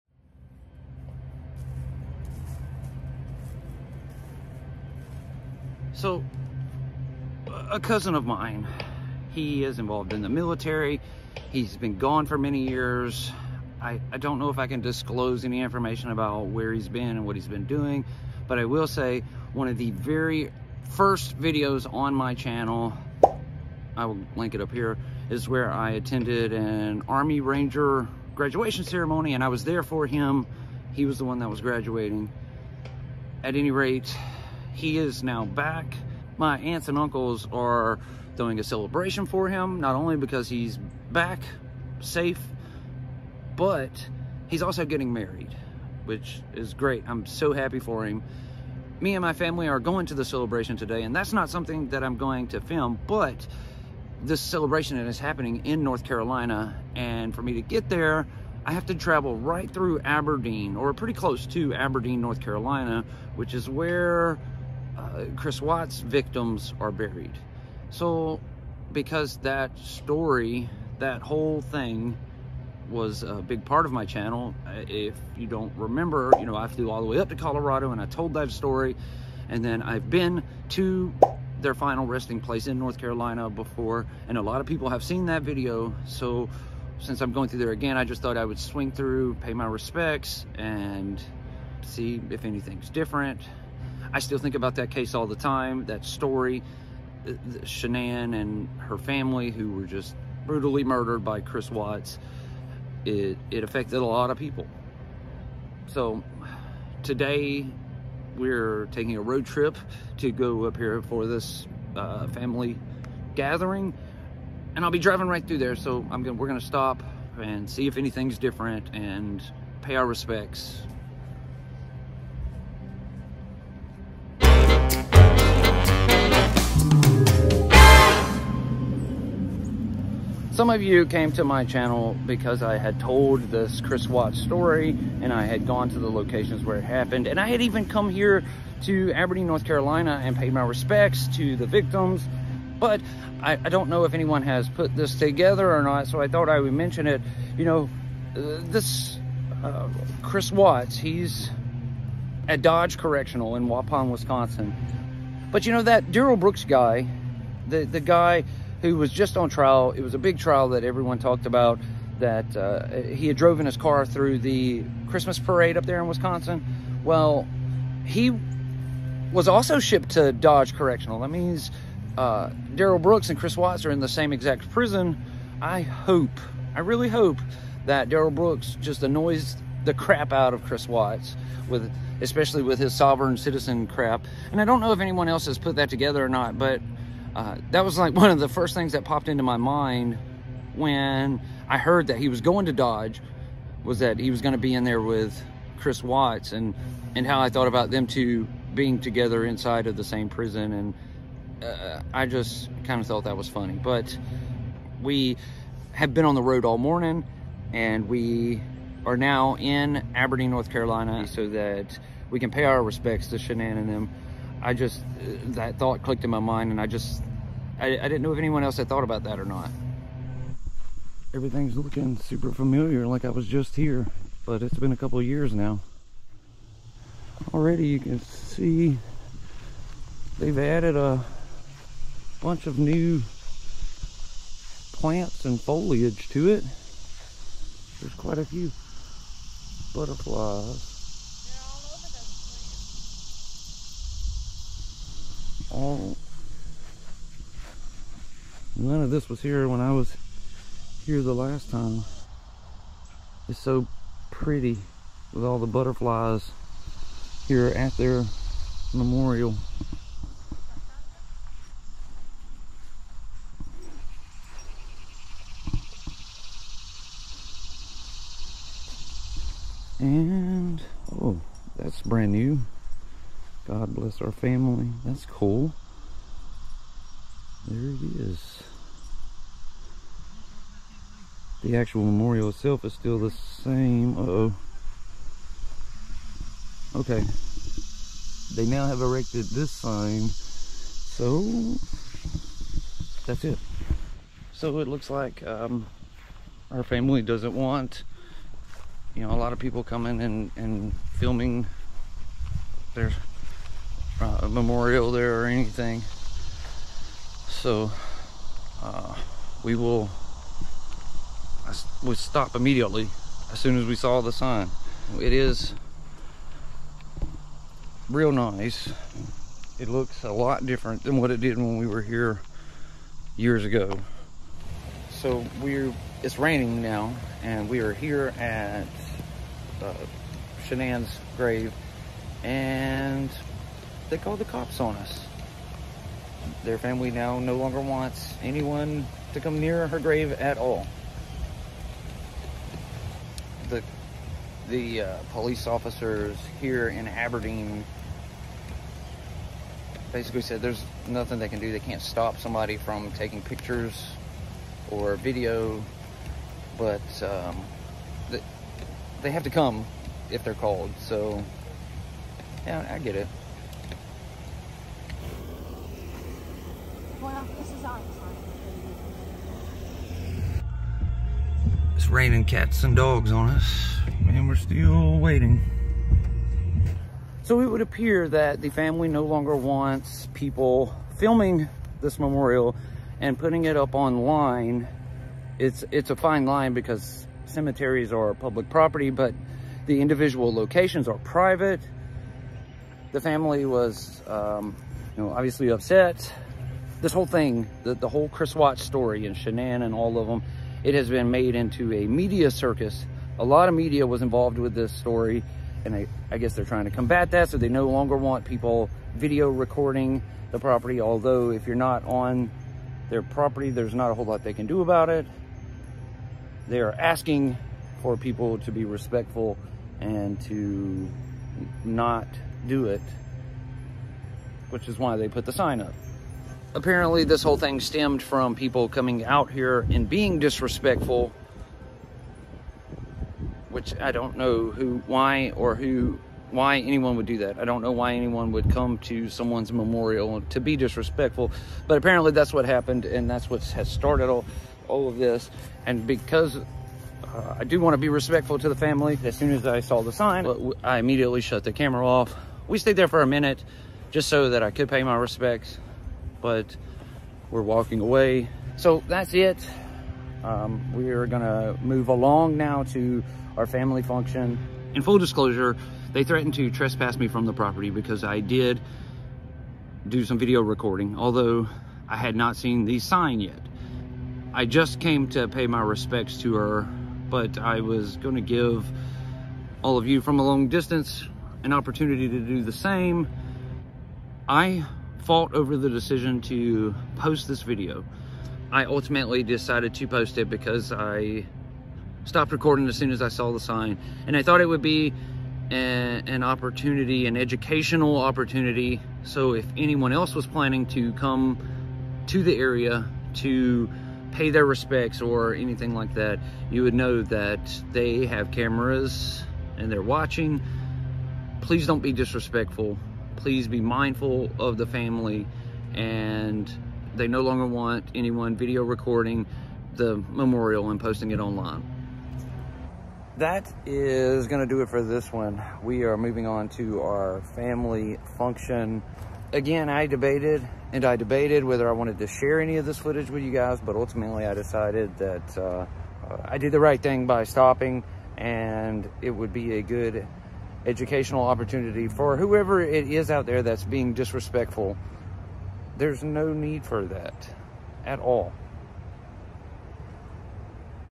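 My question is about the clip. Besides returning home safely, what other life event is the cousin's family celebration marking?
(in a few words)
Getting married.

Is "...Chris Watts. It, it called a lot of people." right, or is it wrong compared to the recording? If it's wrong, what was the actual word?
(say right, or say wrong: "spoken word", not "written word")
wrong: "affected", not "called".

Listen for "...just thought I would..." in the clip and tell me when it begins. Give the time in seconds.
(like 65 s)
88 s.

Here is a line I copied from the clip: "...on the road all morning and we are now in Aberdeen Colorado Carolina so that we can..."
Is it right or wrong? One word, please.
wrong.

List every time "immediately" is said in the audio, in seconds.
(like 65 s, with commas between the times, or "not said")
312 s, 450 s.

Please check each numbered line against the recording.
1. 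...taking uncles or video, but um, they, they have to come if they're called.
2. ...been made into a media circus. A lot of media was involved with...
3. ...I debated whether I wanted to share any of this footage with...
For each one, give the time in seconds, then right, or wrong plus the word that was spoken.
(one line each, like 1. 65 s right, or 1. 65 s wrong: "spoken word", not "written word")
1. 353 s wrong: "pictures", not "uncles"
2. 401 s right
3. 531 s right.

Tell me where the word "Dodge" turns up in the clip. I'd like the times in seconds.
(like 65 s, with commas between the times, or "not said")
152 s, 170 s, 192 s.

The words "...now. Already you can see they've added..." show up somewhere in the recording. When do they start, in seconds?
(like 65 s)
225 s.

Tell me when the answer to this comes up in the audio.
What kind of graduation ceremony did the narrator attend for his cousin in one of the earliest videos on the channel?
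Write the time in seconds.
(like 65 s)
27 s.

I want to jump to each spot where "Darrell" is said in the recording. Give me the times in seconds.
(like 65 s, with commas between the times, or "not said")
156 s, 172 s, 178 s.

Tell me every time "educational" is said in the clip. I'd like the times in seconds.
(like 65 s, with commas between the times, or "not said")
497 s, 540 s.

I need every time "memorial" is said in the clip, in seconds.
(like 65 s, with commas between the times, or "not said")
258 s, 282 s, 304 s, 382 s, 439 s, 520 s.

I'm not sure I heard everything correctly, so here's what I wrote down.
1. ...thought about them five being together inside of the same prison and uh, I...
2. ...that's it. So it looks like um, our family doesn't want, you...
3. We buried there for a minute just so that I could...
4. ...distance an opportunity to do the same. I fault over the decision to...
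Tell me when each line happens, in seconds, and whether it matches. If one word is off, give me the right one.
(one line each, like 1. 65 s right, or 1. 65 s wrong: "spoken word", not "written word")
1. 197 s wrong: "two", not "five"
2. 293 s right
3. 452 s wrong: "stayed", not "buried"
4. 480 s right.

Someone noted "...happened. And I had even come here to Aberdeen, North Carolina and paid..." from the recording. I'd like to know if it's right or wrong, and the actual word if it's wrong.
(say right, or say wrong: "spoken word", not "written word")
right.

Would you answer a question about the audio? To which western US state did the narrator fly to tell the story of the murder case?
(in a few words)
Colorado.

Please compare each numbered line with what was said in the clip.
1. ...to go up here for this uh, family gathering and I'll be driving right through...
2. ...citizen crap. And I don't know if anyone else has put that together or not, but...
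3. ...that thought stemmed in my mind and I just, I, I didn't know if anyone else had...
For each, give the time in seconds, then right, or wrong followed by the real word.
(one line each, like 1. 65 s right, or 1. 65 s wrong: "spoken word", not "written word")
1. 110 s right
2. 183 s right
3. 215 s wrong: "clicked", not "stemmed".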